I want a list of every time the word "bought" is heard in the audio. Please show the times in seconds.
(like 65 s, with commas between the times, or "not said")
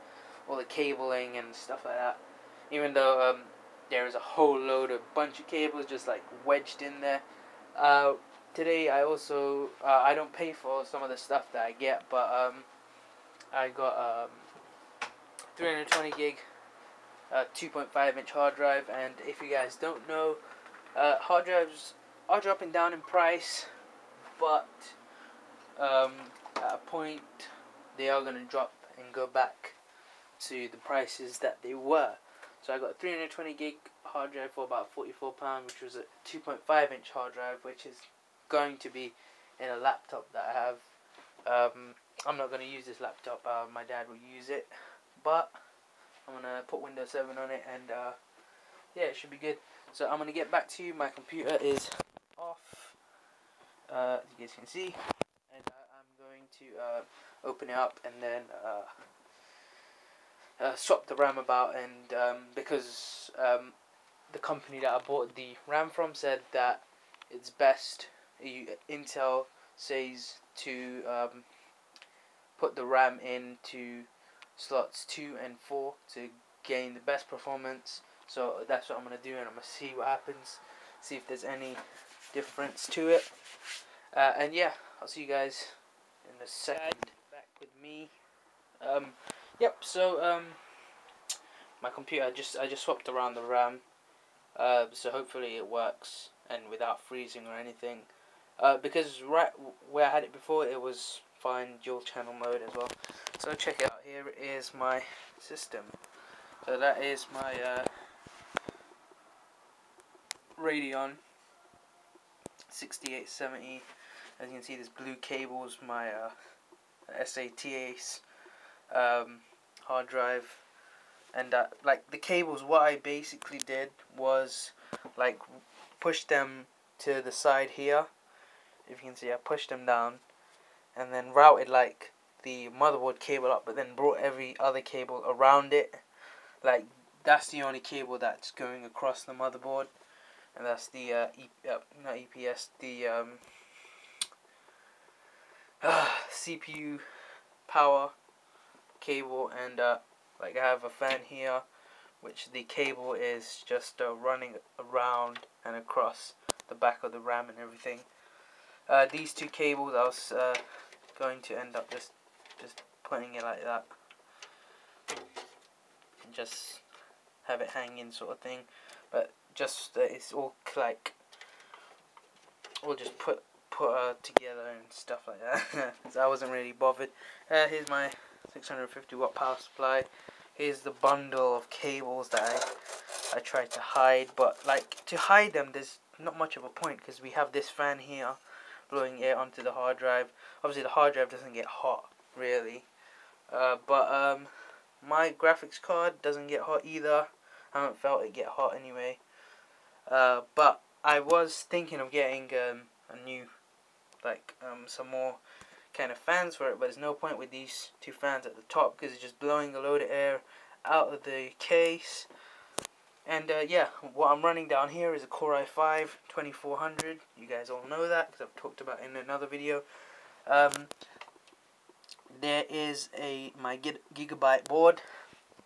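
65 s.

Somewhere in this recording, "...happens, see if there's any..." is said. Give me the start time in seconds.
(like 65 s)
80 s.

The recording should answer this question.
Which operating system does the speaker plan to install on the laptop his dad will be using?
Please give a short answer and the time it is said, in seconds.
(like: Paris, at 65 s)
Windows 7, at 46 s.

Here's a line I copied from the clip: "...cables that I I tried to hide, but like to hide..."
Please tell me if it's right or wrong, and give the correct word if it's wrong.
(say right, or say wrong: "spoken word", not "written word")
right.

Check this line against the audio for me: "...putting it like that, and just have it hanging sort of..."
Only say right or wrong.
right.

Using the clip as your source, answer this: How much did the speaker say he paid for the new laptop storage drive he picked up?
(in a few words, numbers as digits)
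44 pounds.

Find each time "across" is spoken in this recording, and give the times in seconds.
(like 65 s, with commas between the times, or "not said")
138 s, 155 s.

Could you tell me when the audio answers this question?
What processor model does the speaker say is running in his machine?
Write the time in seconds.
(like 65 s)
215 s.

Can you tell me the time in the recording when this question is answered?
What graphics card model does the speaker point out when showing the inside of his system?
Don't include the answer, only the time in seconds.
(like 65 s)
110 s.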